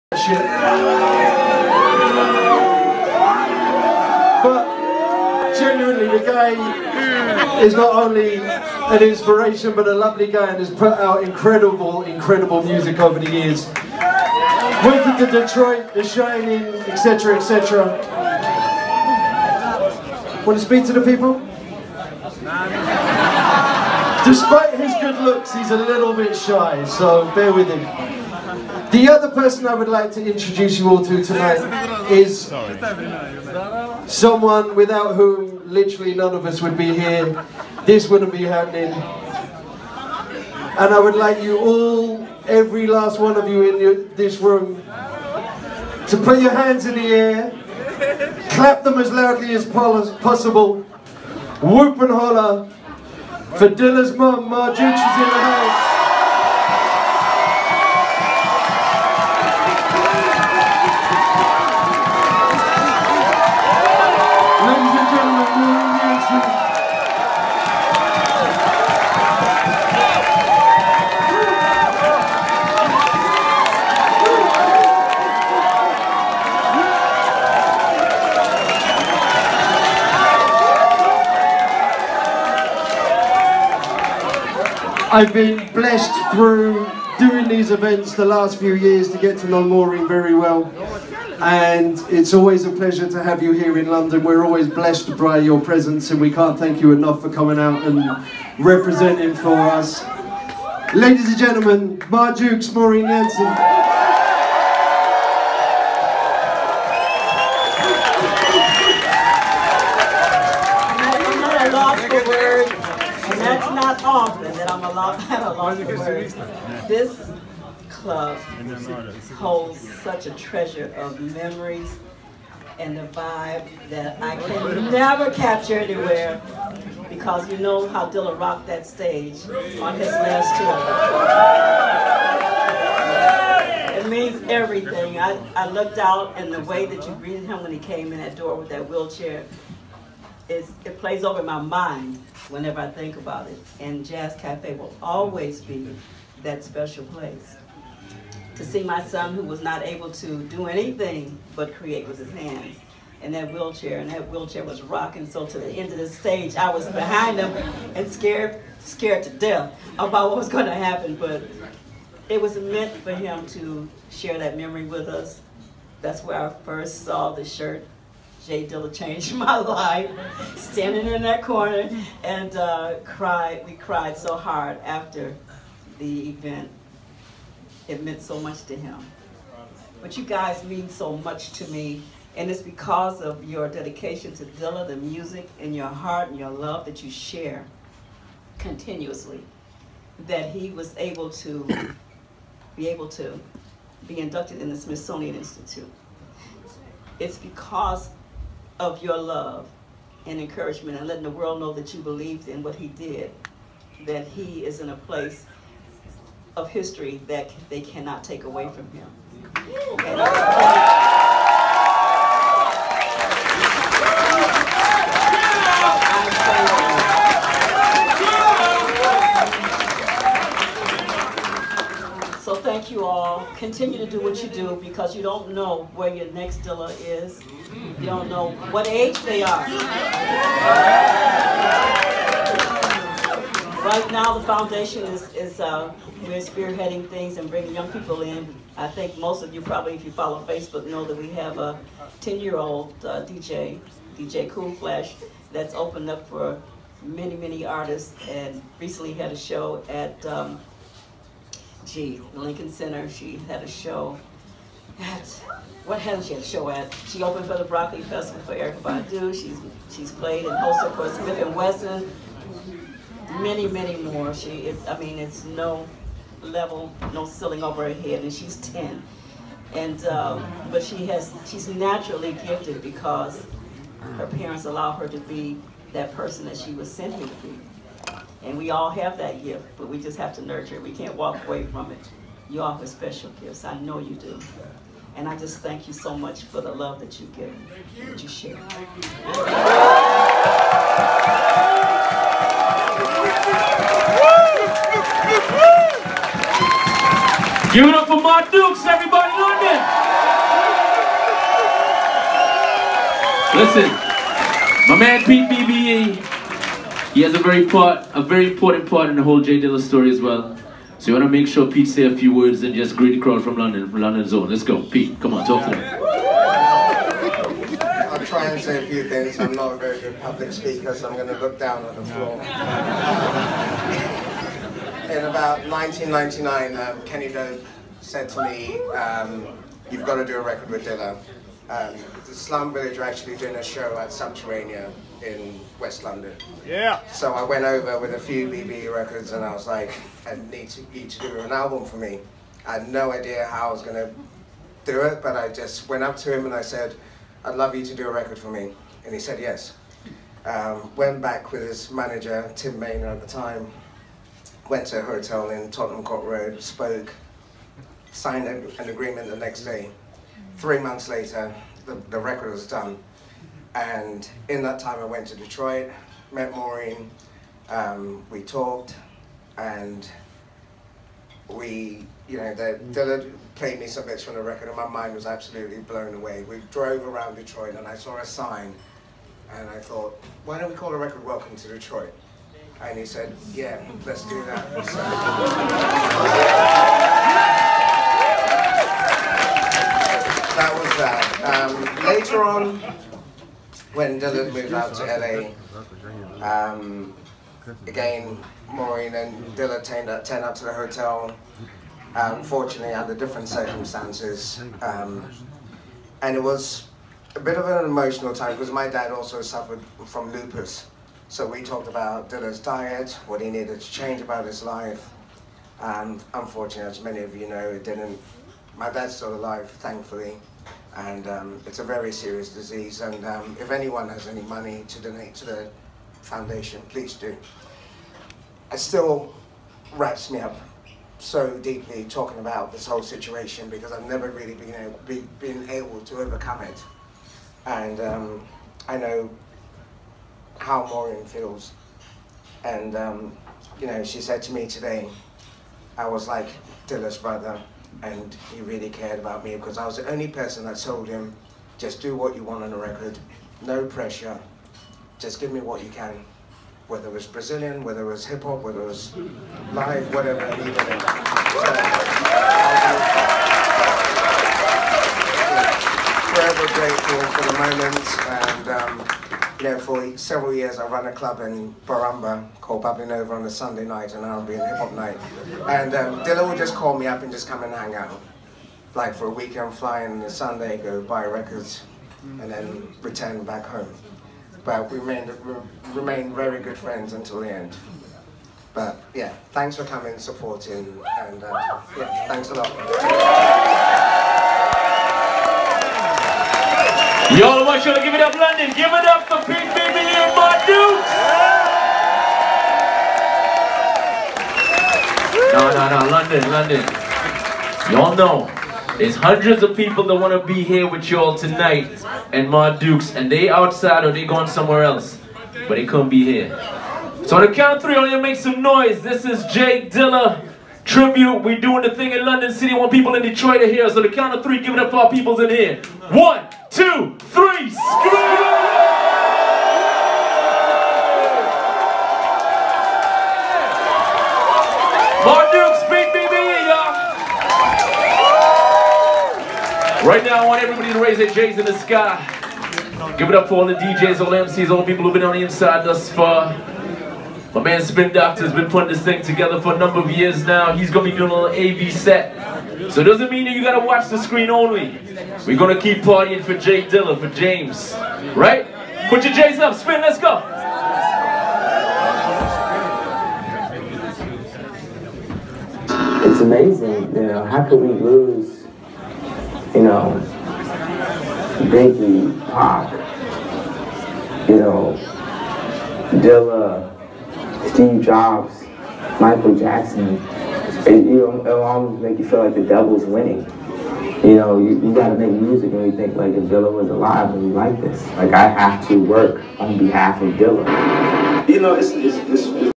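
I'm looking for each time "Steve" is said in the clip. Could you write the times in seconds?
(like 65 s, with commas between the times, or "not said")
577 s.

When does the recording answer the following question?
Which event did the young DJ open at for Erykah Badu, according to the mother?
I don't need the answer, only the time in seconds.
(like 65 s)
257 s.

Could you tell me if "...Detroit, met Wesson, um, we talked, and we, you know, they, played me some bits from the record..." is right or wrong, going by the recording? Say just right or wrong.
wrong.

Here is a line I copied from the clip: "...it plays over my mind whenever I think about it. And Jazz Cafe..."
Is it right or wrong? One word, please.
right.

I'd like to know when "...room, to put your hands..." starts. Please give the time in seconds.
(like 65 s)
44 s.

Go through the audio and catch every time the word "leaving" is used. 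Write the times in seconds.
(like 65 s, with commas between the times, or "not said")
not said.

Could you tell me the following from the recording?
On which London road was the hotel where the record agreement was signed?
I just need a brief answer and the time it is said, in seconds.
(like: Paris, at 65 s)
Tottenham Court Road, at 355 s.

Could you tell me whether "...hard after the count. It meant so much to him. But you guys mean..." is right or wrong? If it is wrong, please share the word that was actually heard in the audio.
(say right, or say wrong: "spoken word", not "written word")
wrong: "event", not "count".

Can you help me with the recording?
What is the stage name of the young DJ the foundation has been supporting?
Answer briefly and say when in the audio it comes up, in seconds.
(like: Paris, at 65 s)
DJ Cool Flash, at 244 s.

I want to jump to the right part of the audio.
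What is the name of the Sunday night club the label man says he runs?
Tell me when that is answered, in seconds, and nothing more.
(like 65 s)
472 s.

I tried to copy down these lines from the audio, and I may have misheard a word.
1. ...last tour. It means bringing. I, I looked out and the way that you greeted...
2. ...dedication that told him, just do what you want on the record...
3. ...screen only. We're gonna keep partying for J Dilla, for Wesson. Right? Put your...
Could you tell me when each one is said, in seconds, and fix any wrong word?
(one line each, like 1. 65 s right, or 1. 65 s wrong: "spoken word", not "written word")
1. 130 s wrong: "everything", not "bringing"
2. 450 s wrong: "person", not "dedication"
3. 554 s wrong: "James", not "Wesson".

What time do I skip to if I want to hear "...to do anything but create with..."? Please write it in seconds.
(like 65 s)
150 s.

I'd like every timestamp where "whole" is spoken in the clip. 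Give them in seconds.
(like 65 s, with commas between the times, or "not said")
309 s, 432 s.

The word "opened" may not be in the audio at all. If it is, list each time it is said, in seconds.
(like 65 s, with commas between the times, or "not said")
245 s, 257 s.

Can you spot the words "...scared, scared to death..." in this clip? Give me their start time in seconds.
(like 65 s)
158 s.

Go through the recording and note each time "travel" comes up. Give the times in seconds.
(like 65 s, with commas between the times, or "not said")
not said.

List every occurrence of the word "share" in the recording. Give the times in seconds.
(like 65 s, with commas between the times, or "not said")
164 s, 187 s, 288 s.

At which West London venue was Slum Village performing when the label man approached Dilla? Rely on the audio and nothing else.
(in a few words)
Subterranean.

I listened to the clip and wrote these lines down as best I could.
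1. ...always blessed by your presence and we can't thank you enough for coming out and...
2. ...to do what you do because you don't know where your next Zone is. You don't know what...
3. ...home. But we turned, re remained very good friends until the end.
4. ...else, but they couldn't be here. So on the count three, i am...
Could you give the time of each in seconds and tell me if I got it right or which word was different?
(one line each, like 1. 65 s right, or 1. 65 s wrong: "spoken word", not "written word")
1. 94 s right
2. 223 s wrong: "Dilla", not "Zone"
3. 483 s wrong: "remained", not "turned"
4. 514 s right.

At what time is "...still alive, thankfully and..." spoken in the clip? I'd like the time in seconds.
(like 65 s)
419 s.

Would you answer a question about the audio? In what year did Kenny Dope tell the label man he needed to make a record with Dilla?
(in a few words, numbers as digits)
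1999.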